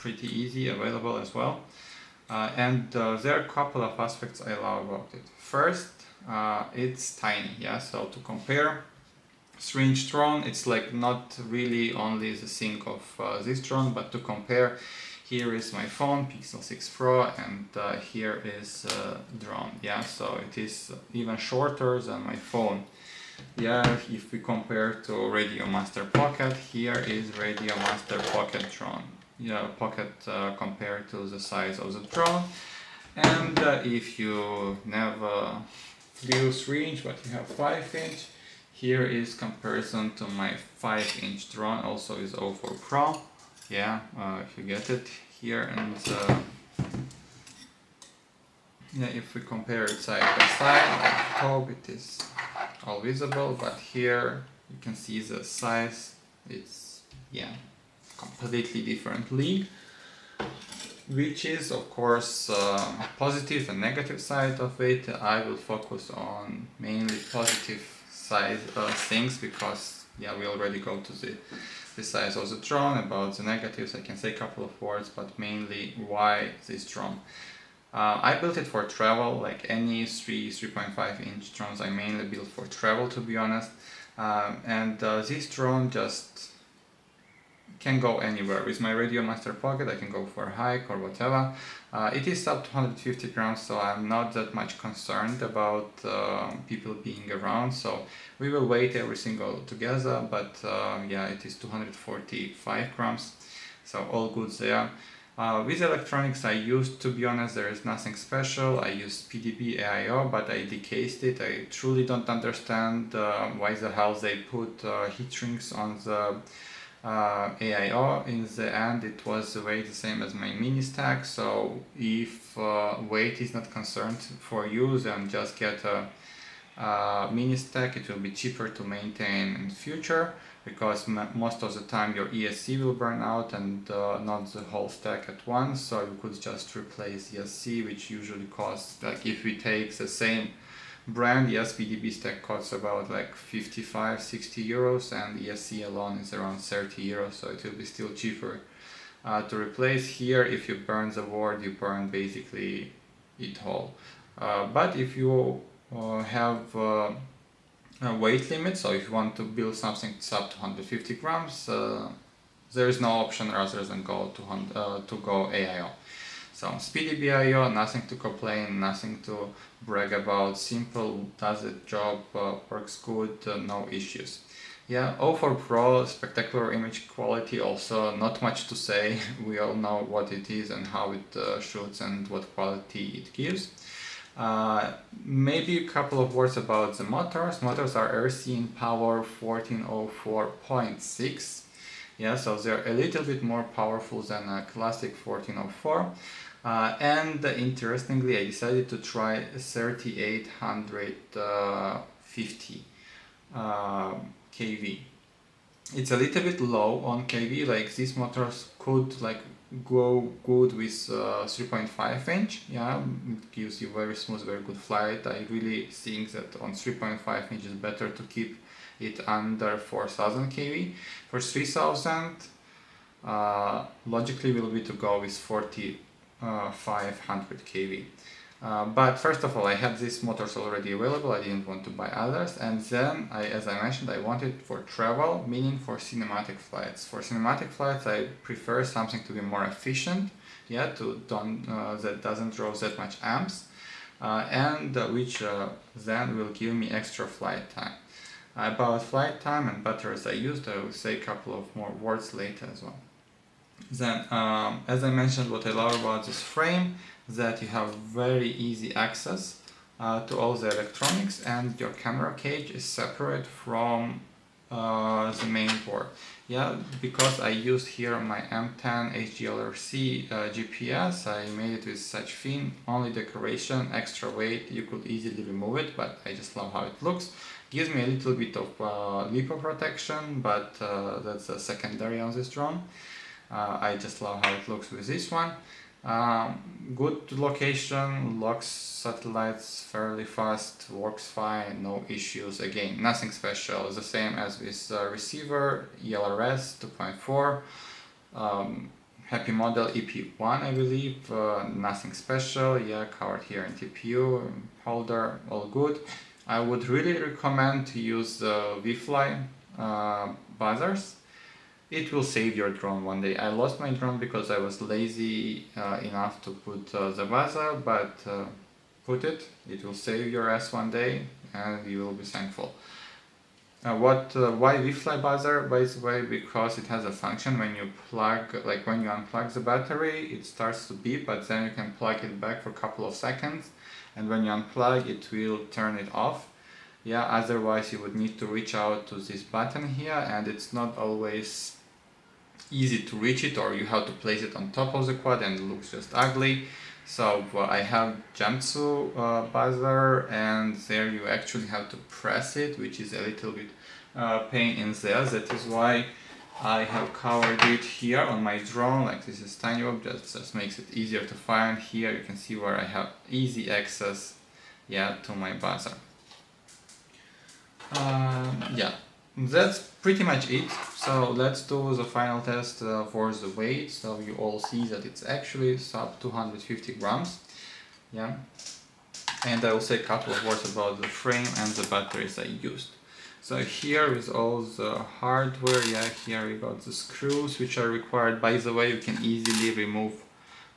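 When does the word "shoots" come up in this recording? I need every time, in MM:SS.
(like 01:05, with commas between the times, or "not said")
03:01.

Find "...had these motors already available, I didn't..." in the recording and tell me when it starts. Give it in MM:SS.
03:49.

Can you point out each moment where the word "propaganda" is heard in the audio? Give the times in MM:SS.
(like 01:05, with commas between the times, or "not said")
not said.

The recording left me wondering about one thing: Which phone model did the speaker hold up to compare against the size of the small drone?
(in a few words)
Pixel 6 Pro.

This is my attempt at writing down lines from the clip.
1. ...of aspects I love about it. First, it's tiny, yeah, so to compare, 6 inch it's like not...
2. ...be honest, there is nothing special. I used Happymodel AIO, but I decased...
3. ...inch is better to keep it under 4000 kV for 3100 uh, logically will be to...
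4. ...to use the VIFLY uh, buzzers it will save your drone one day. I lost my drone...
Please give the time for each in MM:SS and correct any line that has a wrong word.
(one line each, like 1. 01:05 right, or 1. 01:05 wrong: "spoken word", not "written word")
1. 00:03 wrong: "3", not "6"
2. 01:47 wrong: "SpeedyBee", not "Happymodel"
3. 03:37 wrong: "3000", not "3100"
4. 05:07 right.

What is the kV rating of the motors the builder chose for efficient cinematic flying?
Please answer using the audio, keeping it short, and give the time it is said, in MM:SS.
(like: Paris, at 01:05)
3850, at 03:19.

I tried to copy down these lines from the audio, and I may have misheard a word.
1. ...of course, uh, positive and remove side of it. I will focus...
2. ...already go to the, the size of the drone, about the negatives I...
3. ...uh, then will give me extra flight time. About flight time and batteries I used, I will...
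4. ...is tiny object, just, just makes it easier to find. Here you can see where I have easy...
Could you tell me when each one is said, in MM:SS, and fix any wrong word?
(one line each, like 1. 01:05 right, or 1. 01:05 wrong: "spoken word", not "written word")
1. 01:01 wrong: "negative", not "remove"
2. 01:10 right
3. 04:05 right
4. 05:59 right.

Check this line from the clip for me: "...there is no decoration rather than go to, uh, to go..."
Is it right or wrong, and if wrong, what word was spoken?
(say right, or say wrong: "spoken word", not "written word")
wrong: "option", not "decoration".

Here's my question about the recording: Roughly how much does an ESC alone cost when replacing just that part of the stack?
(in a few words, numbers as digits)
30 euros.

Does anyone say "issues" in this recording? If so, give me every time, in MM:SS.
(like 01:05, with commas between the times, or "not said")
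02:53, 04:52.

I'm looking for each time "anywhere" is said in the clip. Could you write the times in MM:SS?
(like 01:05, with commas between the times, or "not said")
01:28.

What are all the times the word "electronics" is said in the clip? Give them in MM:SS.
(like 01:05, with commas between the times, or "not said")
01:45, 04:20.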